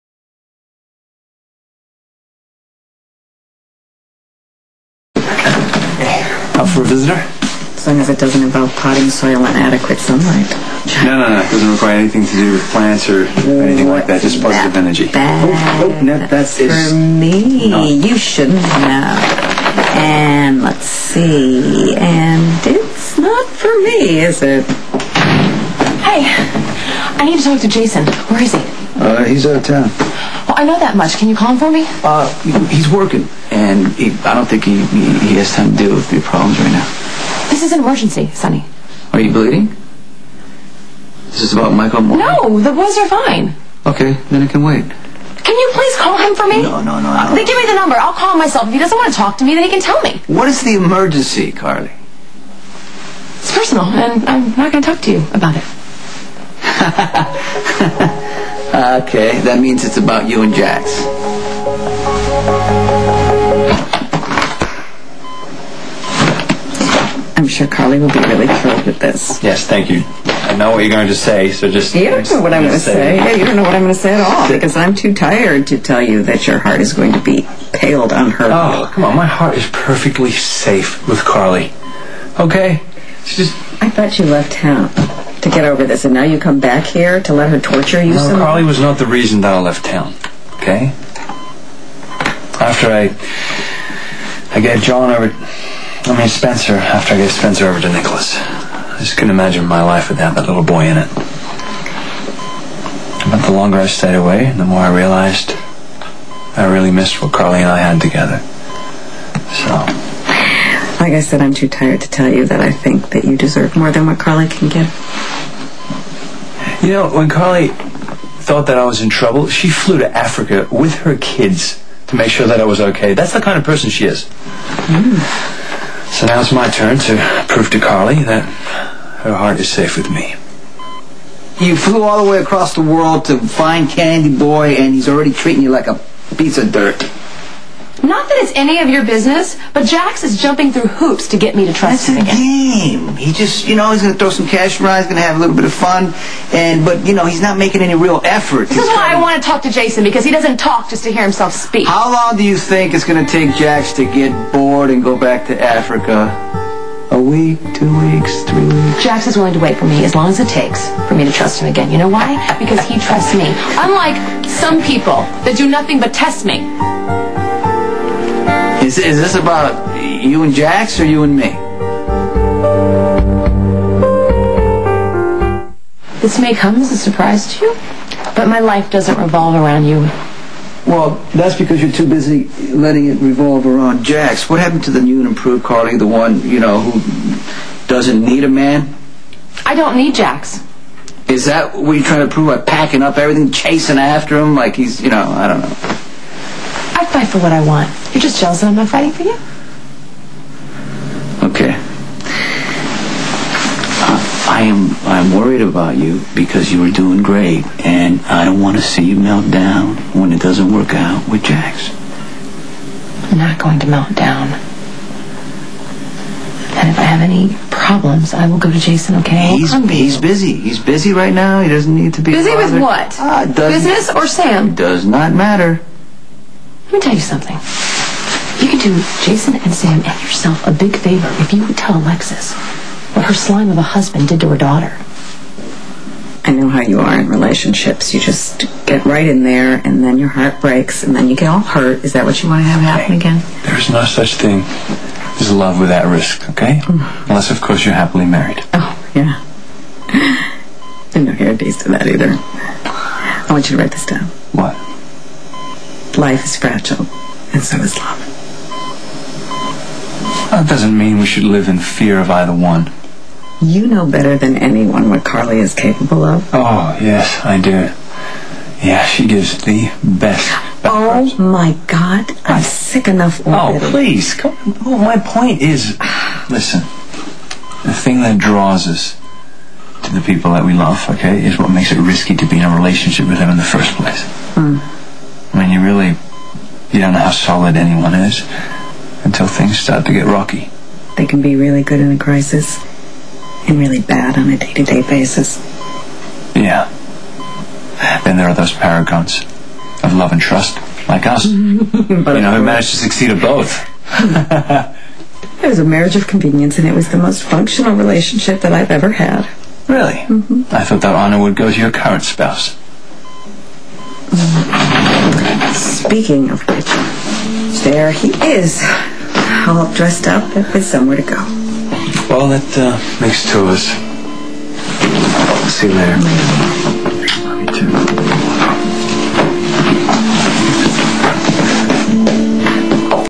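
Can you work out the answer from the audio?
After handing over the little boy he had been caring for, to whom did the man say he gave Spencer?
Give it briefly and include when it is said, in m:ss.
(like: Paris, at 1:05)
Nicholas, at 1:37.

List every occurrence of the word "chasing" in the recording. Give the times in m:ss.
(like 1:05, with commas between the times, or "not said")
3:13.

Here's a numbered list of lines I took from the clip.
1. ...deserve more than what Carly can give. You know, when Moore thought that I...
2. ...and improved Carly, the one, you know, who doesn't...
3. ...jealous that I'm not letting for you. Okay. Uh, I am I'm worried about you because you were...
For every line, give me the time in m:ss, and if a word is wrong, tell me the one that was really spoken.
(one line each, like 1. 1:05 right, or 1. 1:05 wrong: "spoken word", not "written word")
1. 1:53 wrong: "Carly", not "Moore"
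2. 3:05 right
3. 3:18 wrong: "fighting", not "letting".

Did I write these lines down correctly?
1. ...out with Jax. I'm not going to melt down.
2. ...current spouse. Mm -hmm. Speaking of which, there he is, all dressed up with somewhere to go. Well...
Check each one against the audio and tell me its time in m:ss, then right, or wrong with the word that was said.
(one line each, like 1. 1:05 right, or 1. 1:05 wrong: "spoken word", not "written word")
1. 3:30 right
2. 5:11 right.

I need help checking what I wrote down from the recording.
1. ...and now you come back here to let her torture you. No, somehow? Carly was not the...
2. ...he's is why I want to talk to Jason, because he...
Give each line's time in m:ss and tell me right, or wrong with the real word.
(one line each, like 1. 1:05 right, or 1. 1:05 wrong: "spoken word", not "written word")
1. 1:26 right
2. 2:28 right.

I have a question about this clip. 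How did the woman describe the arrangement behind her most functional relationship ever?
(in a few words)
marriage of convenience.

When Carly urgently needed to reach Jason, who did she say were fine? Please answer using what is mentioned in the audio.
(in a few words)
the boys.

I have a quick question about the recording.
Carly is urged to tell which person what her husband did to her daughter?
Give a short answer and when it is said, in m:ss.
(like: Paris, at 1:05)
Alexis, at 3:51.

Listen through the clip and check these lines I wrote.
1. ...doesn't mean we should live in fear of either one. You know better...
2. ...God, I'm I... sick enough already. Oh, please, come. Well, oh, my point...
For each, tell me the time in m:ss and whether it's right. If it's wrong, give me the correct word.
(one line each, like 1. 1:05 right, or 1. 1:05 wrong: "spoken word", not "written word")
1. 4:20 right
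2. 4:31 right.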